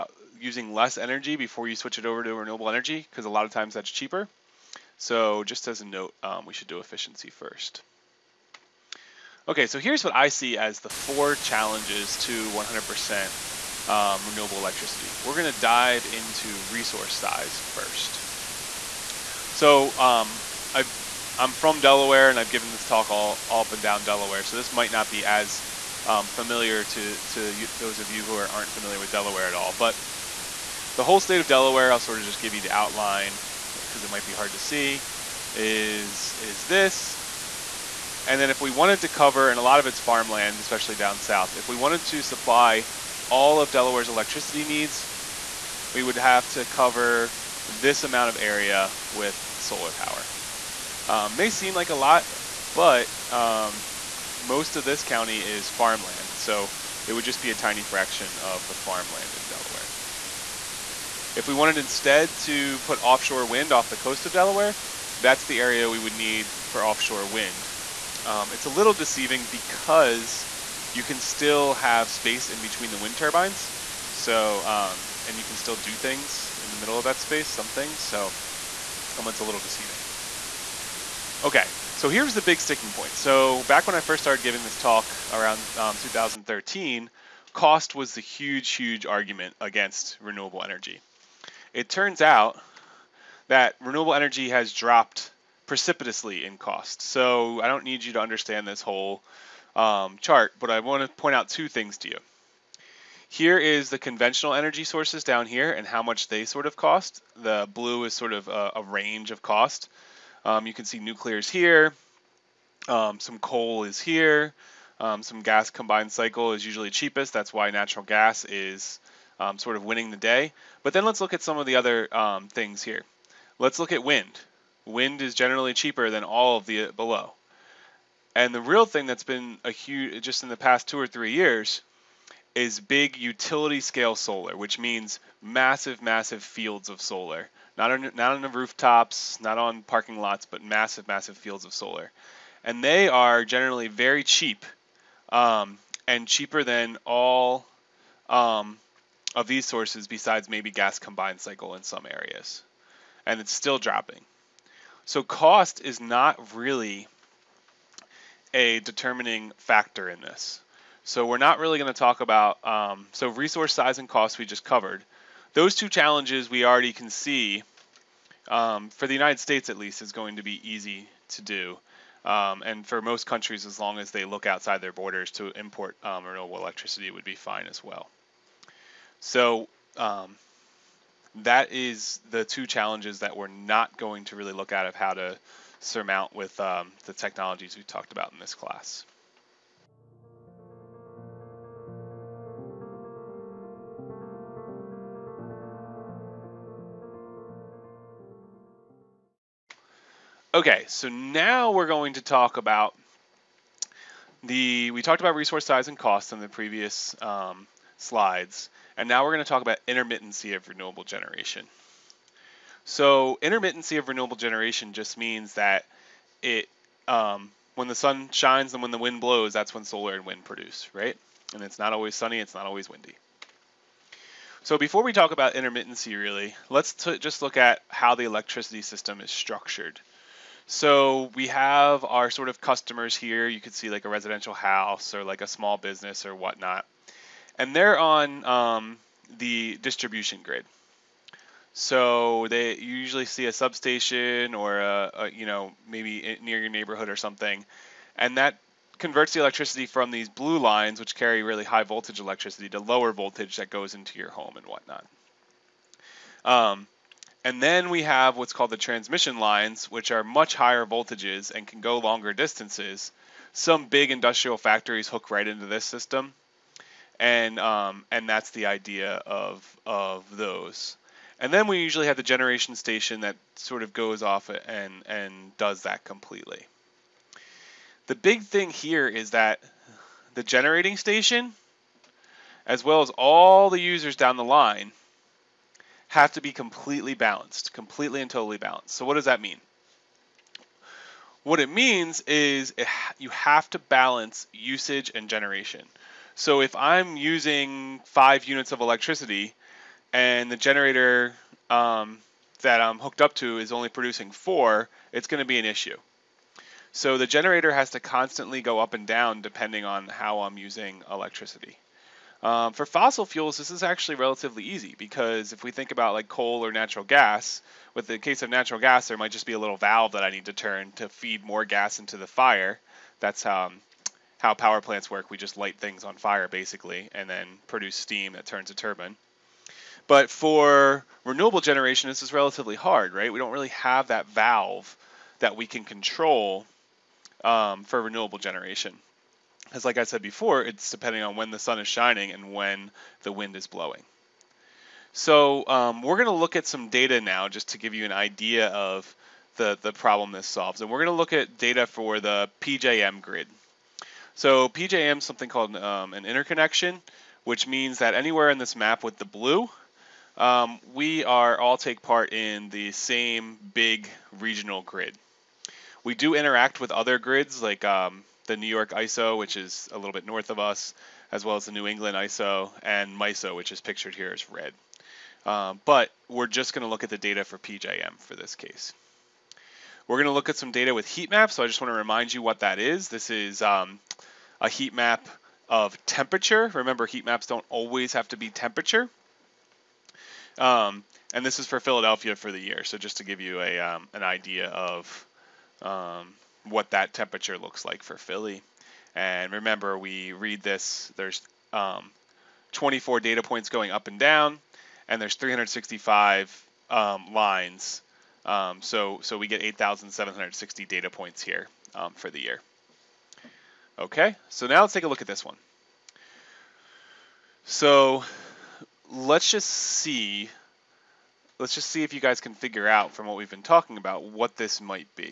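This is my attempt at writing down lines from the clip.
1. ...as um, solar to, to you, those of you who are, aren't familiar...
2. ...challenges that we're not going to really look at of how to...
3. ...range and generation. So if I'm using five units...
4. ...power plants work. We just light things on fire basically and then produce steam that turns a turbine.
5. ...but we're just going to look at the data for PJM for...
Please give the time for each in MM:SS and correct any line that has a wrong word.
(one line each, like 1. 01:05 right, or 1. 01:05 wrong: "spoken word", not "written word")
1. 00:25 wrong: "familiar", not "solar"
2. 03:02 right
3. 04:54 wrong: "usage", not "range"
4. 05:24 right
5. 06:15 right.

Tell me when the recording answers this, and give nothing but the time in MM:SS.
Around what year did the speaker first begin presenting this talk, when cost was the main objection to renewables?
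01:25.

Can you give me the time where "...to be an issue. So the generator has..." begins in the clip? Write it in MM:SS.
05:05.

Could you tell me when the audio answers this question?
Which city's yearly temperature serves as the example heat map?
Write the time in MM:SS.
06:31.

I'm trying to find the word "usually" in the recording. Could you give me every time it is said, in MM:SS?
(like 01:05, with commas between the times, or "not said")
01:56, 04:02, 04:31.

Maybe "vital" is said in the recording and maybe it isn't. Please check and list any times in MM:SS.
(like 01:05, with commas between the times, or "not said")
not said.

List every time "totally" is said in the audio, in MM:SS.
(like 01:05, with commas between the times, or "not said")
04:48.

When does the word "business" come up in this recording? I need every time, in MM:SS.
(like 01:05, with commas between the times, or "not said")
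03:55.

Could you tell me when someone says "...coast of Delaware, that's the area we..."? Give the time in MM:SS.
01:03.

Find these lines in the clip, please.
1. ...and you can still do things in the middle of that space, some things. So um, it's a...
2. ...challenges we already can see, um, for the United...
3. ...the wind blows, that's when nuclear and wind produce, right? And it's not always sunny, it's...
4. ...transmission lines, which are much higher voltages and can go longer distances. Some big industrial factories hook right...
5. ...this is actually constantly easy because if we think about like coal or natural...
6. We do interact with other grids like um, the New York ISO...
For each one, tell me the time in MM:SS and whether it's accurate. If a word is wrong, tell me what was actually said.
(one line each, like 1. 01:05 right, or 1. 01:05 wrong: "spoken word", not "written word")
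1. 01:15 right
2. 02:45 right
3. 03:38 wrong: "solar", not "nuclear"
4. 04:18 right
5. 05:13 wrong: "relatively", not "constantly"
6. 06:06 right.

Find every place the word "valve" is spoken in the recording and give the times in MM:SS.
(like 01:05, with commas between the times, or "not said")
05:19, 05:34.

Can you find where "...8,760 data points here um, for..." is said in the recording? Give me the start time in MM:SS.
06:49.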